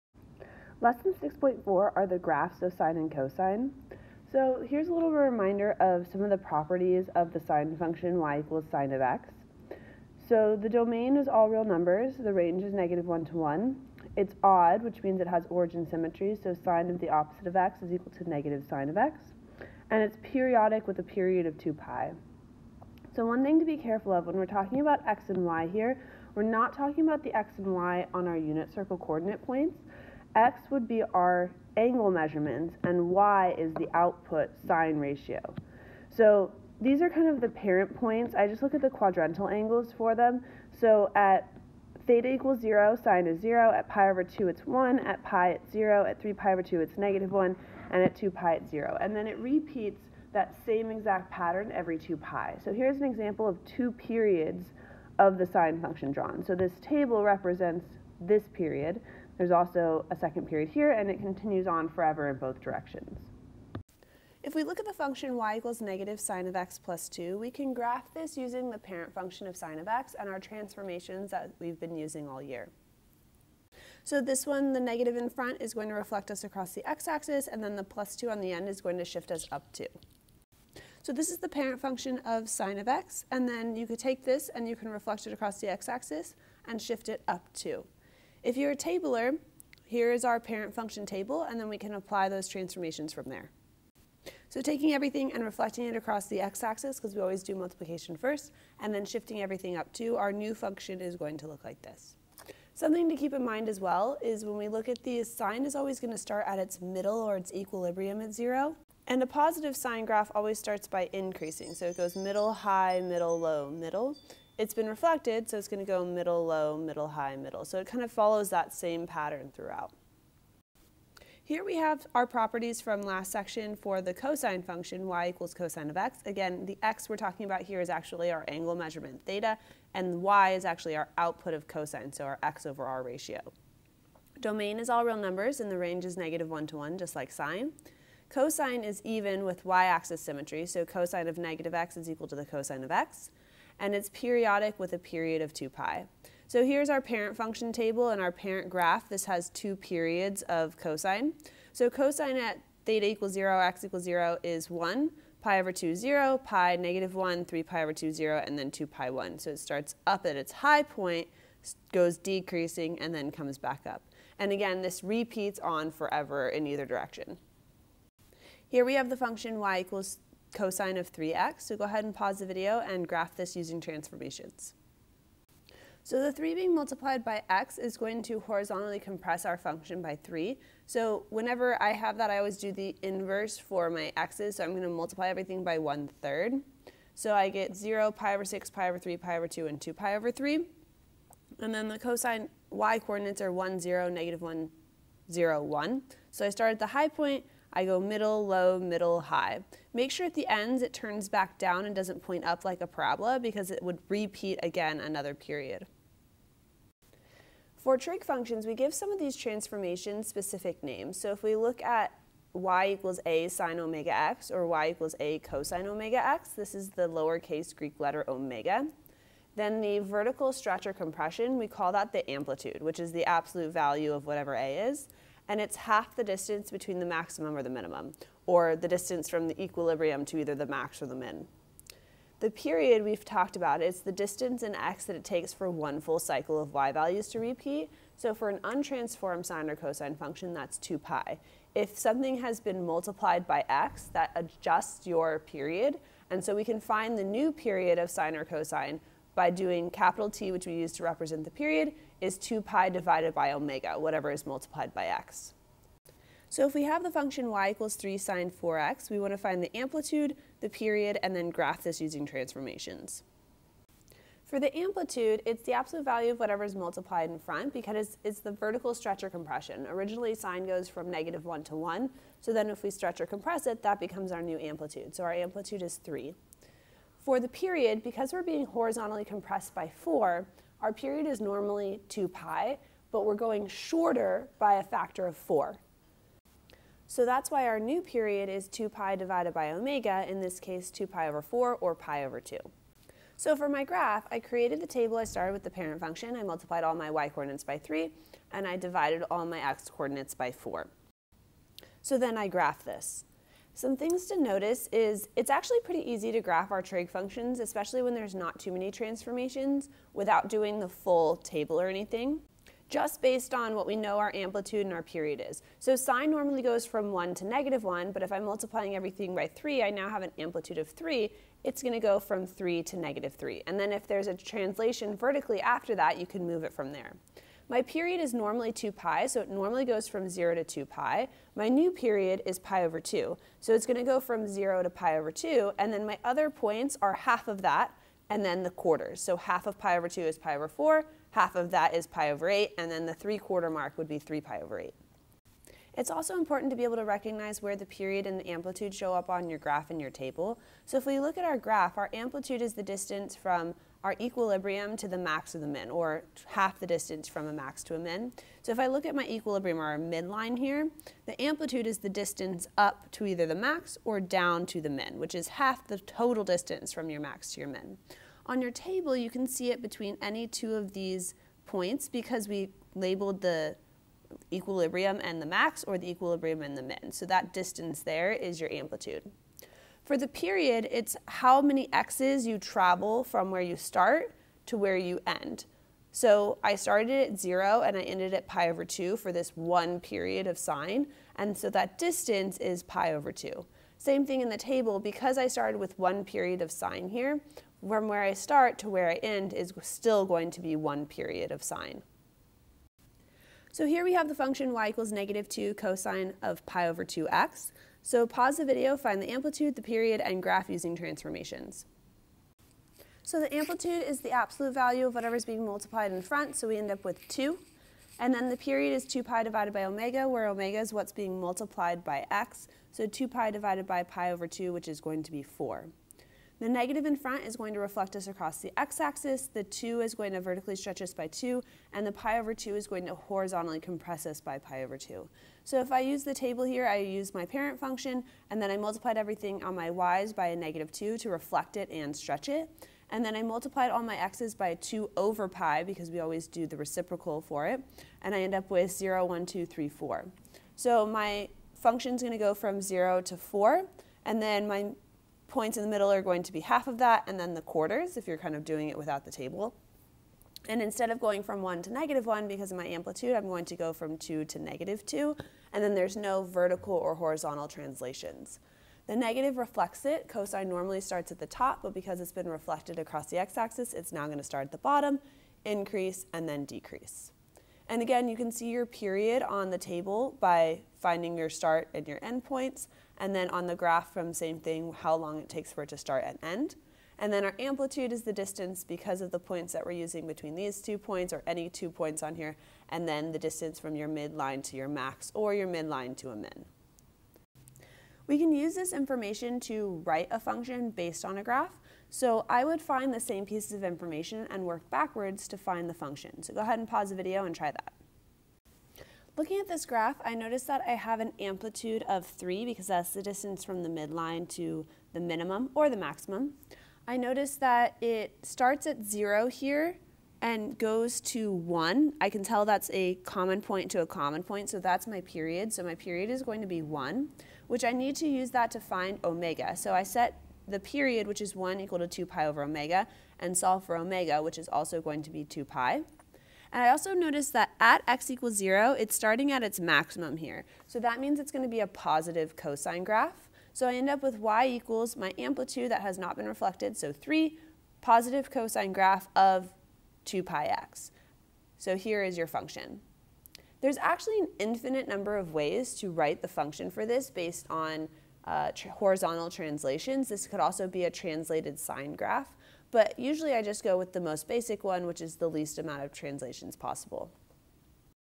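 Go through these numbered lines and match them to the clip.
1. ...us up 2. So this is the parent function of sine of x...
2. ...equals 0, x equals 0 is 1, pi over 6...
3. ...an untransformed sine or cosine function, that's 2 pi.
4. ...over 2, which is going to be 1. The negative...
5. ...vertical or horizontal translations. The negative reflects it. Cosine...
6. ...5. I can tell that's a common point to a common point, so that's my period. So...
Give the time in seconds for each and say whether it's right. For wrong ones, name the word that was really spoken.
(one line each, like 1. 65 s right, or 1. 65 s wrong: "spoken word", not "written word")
1. 79 s right
2. 153 s wrong: "2", not "6"
3. 238 s right
4. 424 s wrong: "4", not "1"
5. 466 s right
6. 521 s wrong: "1", not "5".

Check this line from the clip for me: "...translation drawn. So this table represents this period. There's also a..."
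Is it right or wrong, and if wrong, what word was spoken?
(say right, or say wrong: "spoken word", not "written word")
wrong: "function", not "translation".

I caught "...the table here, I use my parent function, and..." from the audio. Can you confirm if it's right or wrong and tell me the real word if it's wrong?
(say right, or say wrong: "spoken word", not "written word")
right.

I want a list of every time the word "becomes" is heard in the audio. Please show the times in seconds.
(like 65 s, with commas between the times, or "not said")
274 s.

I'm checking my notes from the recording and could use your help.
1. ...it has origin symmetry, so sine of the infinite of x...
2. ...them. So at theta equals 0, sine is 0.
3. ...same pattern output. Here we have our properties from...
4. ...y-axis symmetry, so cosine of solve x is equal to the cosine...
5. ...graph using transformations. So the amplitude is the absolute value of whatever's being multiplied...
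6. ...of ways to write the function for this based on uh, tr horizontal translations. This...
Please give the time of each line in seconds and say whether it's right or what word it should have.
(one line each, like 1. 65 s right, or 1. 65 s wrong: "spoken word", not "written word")
1. 15 s wrong: "opposite", not "infinite"
2. 40 s right
3. 118 s wrong: "throughout", not "output"
4. 139 s wrong: "negative", not "solve"
5. 410 s right
6. 555 s right.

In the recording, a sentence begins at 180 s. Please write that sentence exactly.
So whenever I have that, I always do the inverse for my x's.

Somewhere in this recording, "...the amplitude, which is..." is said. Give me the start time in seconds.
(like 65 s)
222 s.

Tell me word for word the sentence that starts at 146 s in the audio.
So here's our parent function table and our parent graph.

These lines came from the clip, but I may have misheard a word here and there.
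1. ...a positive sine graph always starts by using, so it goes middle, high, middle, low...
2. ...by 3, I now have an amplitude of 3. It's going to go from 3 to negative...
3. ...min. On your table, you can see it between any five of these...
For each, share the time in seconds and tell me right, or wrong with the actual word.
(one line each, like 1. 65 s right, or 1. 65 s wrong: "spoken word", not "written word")
1. 109 s wrong: "increasing", not "using"
2. 319 s right
3. 367 s wrong: "two", not "five".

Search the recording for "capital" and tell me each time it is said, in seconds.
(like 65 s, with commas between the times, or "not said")
249 s.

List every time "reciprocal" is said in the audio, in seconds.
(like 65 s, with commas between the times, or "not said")
446 s.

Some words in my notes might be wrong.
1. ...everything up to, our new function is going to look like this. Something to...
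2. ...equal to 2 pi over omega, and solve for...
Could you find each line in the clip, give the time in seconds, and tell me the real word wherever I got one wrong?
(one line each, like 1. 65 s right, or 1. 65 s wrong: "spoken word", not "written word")
1. 99 s right
2. 531 s right.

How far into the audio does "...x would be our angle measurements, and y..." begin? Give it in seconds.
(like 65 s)
30 s.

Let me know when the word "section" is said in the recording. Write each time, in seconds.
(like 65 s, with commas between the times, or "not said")
123 s.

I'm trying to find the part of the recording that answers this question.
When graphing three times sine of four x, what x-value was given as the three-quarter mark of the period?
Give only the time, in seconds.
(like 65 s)
344 s.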